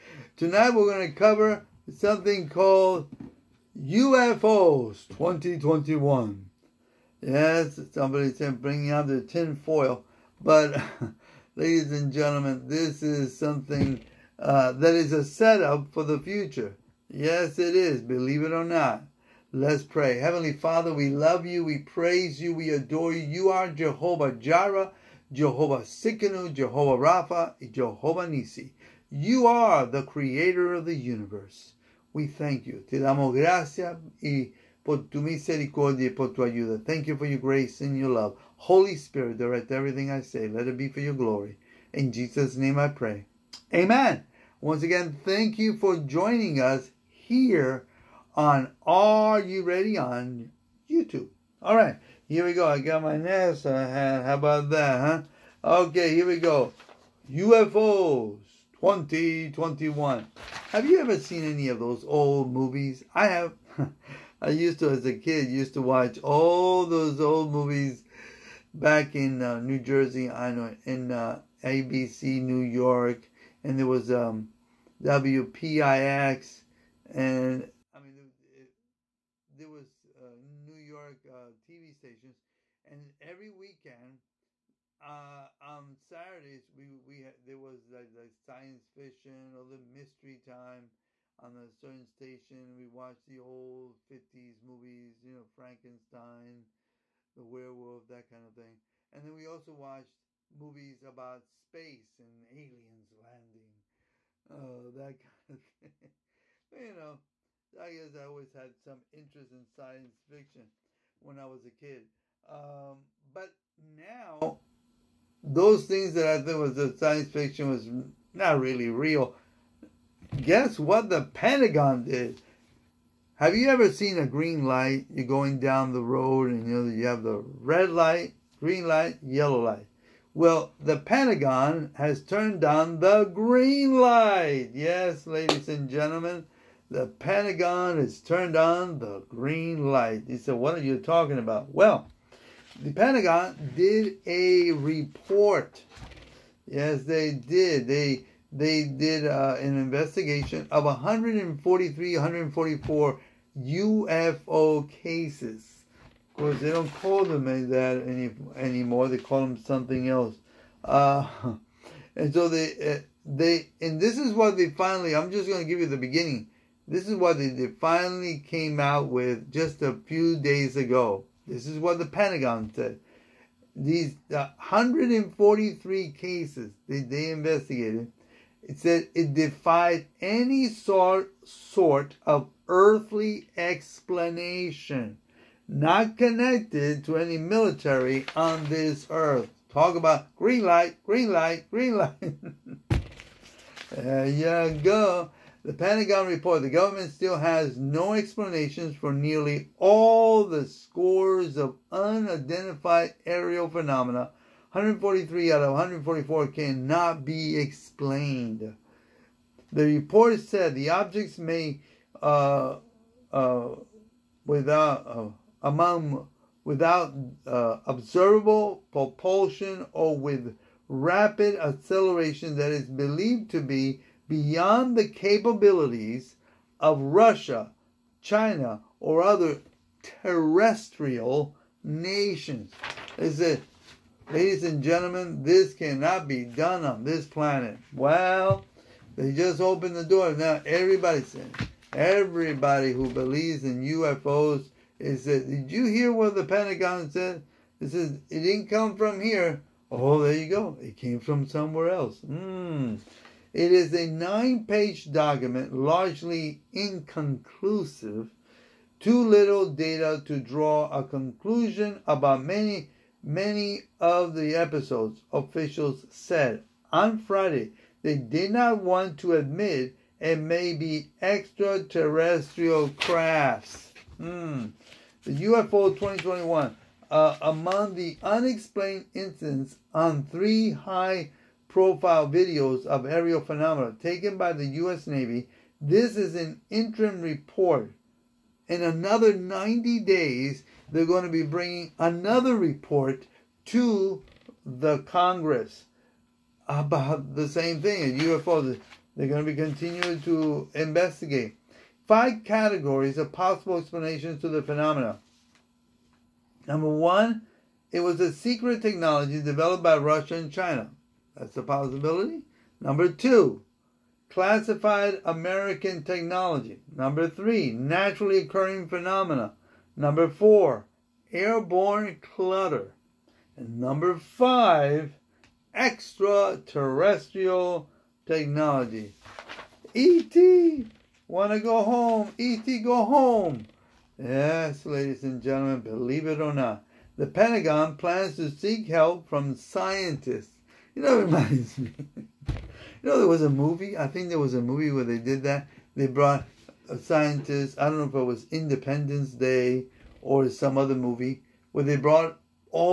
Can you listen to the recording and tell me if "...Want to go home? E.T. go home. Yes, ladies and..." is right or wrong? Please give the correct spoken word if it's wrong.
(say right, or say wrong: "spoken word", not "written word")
right.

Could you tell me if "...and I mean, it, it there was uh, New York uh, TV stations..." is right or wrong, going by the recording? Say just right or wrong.
right.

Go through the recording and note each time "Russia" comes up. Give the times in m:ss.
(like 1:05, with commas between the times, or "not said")
3:47, 5:09.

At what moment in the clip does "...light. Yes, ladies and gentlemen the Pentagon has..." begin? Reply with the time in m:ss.
2:13.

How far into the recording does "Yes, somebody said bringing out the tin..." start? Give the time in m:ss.
0:07.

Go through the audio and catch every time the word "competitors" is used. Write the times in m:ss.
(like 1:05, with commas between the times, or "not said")
not said.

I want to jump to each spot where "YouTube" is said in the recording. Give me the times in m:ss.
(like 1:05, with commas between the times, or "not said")
0:50.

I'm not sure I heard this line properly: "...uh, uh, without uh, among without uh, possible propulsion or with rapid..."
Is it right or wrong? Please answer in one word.
wrong.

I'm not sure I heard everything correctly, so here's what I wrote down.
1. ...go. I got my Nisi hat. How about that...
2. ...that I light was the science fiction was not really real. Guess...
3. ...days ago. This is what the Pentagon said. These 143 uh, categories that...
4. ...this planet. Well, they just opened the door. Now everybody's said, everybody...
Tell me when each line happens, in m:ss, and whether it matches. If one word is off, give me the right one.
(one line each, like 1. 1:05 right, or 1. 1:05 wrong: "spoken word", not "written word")
1. 0:52 wrong: "NASA", not "Nisi"
2. 1:56 wrong: "thought", not "light"
3. 2:50 wrong: "cases", not "categories"
4. 3:57 right.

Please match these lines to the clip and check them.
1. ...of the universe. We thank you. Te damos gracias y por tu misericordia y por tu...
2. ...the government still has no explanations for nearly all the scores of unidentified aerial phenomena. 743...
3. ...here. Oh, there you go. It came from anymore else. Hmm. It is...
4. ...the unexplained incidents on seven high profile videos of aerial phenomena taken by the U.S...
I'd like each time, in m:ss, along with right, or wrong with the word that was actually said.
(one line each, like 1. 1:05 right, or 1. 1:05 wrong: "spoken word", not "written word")
1. 0:30 right
2. 3:16 wrong: "143", not "743"
3. 4:09 wrong: "somewhere", not "anymore"
4. 4:37 wrong: "three", not "seven".